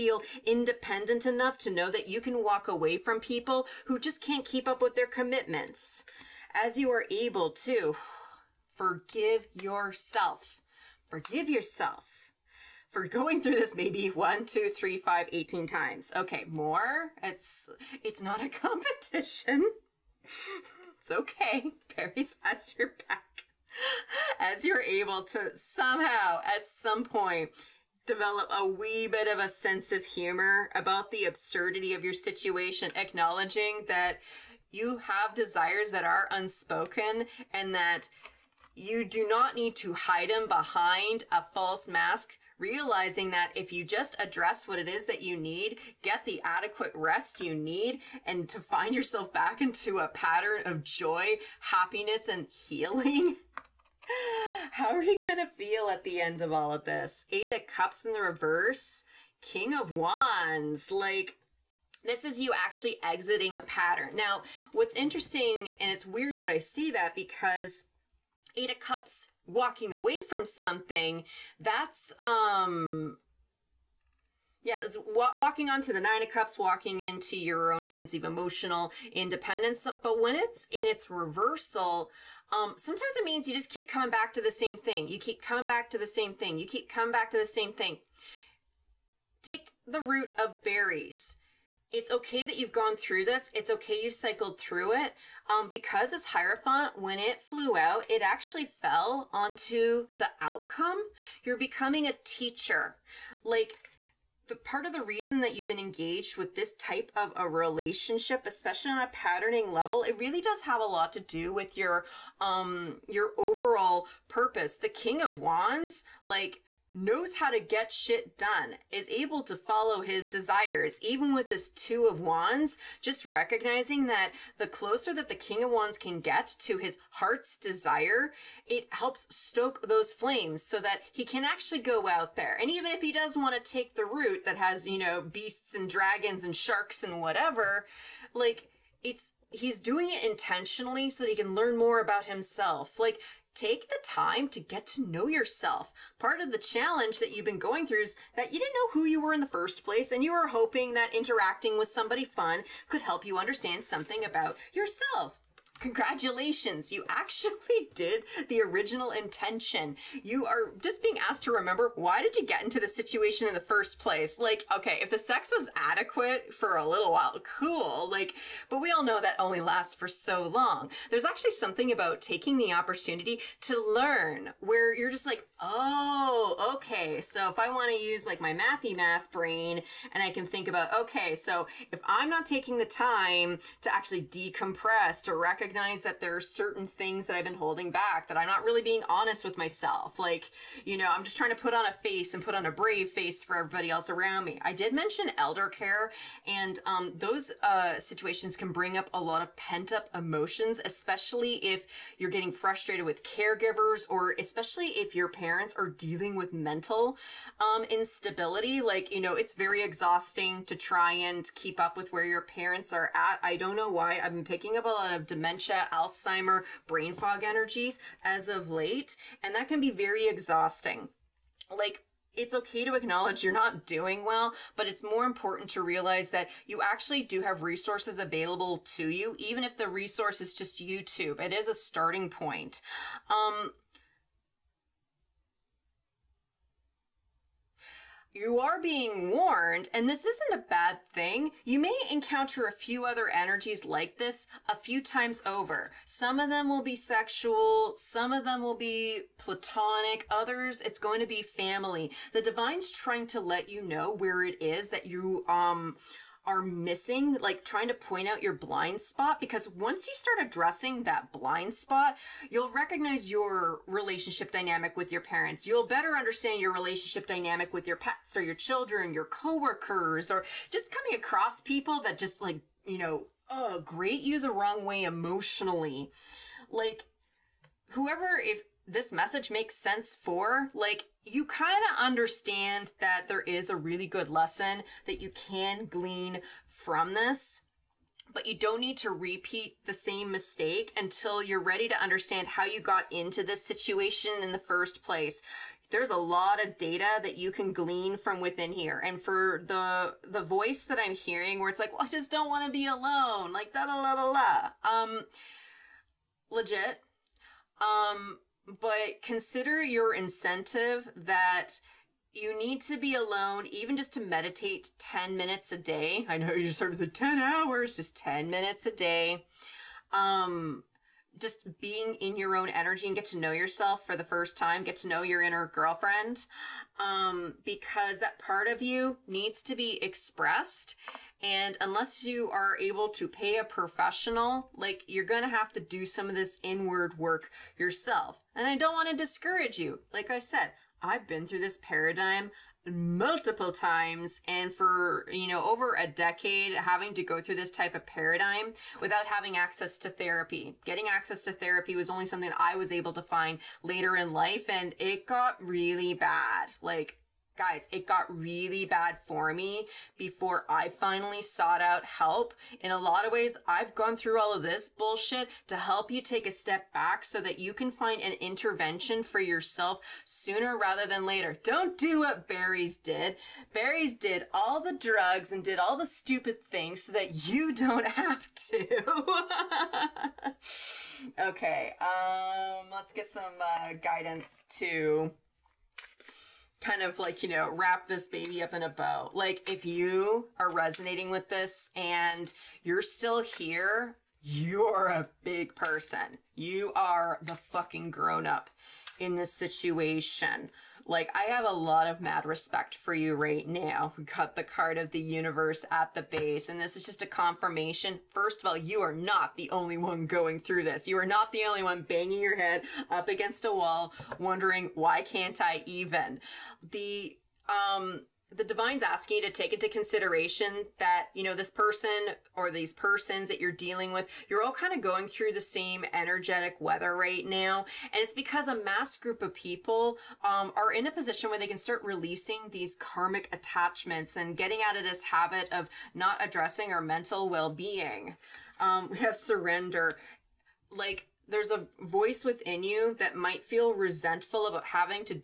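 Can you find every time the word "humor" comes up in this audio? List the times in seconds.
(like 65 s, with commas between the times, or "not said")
30 s.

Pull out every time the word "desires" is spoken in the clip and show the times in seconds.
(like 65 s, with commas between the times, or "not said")
35 s, 120 s, 127 s.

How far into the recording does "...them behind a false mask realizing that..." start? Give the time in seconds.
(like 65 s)
40 s.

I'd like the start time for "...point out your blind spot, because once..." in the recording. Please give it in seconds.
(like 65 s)
257 s.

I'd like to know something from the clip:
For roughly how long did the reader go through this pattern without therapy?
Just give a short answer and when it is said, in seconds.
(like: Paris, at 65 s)
over a decade, at 345 s.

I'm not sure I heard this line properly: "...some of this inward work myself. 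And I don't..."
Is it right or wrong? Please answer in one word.
wrong.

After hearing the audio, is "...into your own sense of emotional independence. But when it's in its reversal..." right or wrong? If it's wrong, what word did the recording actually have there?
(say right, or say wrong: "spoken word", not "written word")
right.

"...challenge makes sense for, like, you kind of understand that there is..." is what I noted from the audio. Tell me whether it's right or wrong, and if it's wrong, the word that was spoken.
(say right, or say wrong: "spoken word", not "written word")
wrong: "message", not "challenge".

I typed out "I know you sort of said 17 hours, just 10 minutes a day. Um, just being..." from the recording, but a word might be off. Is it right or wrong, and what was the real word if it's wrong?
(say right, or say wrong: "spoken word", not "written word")
wrong: "10", not "17".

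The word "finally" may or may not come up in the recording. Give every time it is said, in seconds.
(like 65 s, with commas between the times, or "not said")
360 s.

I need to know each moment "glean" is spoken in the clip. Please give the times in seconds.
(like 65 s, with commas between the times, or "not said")
285 s, 297 s.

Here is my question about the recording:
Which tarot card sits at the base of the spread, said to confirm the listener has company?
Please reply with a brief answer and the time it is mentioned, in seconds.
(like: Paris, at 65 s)
The Universe, at 405 s.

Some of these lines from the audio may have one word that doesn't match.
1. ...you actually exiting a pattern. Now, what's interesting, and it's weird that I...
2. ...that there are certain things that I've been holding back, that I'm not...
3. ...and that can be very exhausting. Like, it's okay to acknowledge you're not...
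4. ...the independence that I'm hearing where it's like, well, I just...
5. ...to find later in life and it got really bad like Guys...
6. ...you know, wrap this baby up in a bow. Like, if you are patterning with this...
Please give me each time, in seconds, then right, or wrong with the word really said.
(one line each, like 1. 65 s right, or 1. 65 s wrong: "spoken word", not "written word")
1. 62 s right
2. 186 s right
3. 219 s right
4. 300 s wrong: "voice", not "independence"
5. 353 s right
6. 387 s wrong: "resonating", not "patterning".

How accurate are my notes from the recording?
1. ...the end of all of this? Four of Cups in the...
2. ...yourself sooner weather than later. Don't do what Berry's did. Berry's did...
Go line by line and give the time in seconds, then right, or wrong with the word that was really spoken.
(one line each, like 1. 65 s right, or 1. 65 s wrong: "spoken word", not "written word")
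1. 56 s wrong: "Eight", not "Four"
2. 369 s wrong: "rather", not "weather".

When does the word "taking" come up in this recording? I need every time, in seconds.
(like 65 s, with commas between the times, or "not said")
172 s, 182 s.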